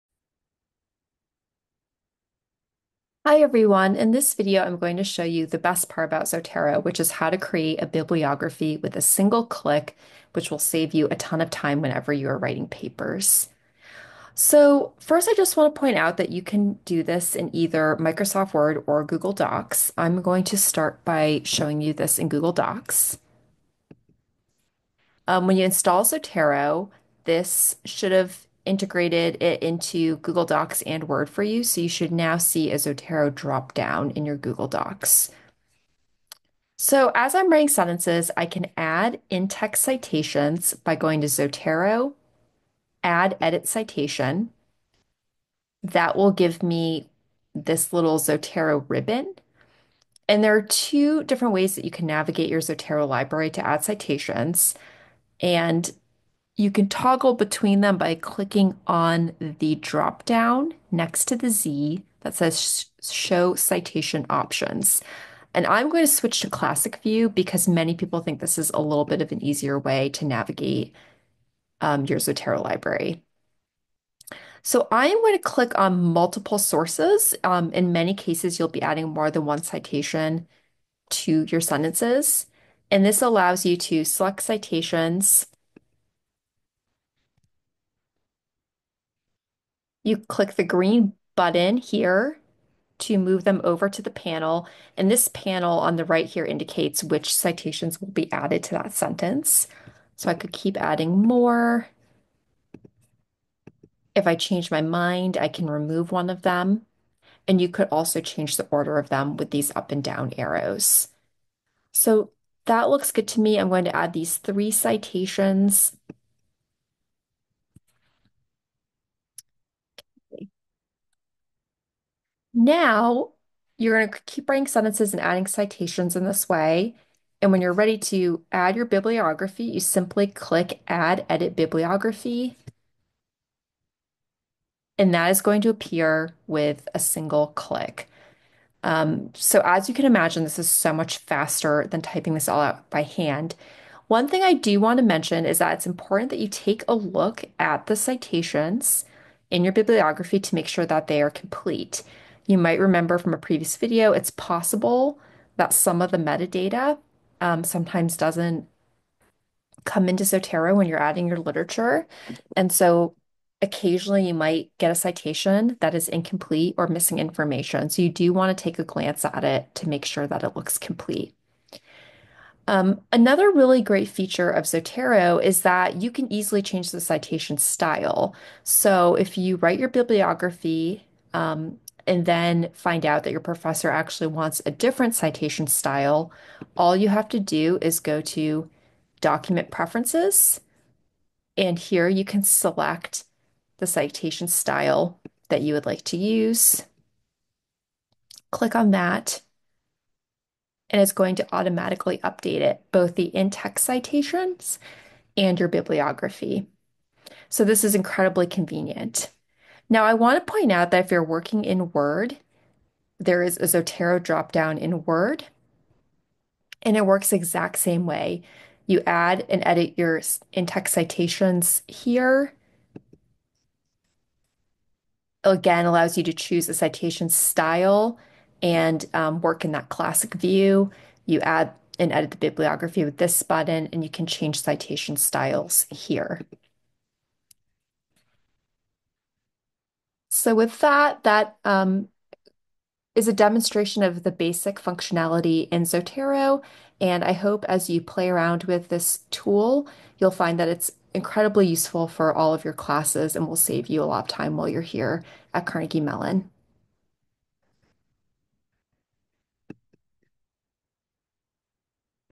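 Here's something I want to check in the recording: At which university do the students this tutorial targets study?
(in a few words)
Carnegie Mellon.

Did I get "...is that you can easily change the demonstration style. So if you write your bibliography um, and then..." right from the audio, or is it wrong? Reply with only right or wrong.
wrong.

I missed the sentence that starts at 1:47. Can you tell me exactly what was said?
And you could also change the order of them with these up and down arrows.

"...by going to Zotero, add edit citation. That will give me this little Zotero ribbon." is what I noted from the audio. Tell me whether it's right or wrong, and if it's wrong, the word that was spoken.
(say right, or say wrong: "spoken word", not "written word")
right.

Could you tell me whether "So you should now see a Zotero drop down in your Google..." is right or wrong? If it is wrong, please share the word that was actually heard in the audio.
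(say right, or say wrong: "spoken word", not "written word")
right.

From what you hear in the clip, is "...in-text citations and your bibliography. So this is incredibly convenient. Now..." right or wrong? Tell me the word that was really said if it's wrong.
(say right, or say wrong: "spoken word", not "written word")
right.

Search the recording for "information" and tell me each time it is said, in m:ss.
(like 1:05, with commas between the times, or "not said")
2:47.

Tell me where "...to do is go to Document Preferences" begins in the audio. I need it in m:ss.
3:07.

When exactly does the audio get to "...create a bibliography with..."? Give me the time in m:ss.
0:07.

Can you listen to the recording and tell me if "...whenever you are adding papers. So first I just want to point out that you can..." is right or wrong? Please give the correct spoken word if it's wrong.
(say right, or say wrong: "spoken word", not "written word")
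wrong: "writing", not "adding".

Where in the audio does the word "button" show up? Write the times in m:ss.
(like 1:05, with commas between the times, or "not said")
1:31, 3:53.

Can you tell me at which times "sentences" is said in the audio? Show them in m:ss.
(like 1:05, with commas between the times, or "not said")
0:37, 1:21, 1:38, 2:04.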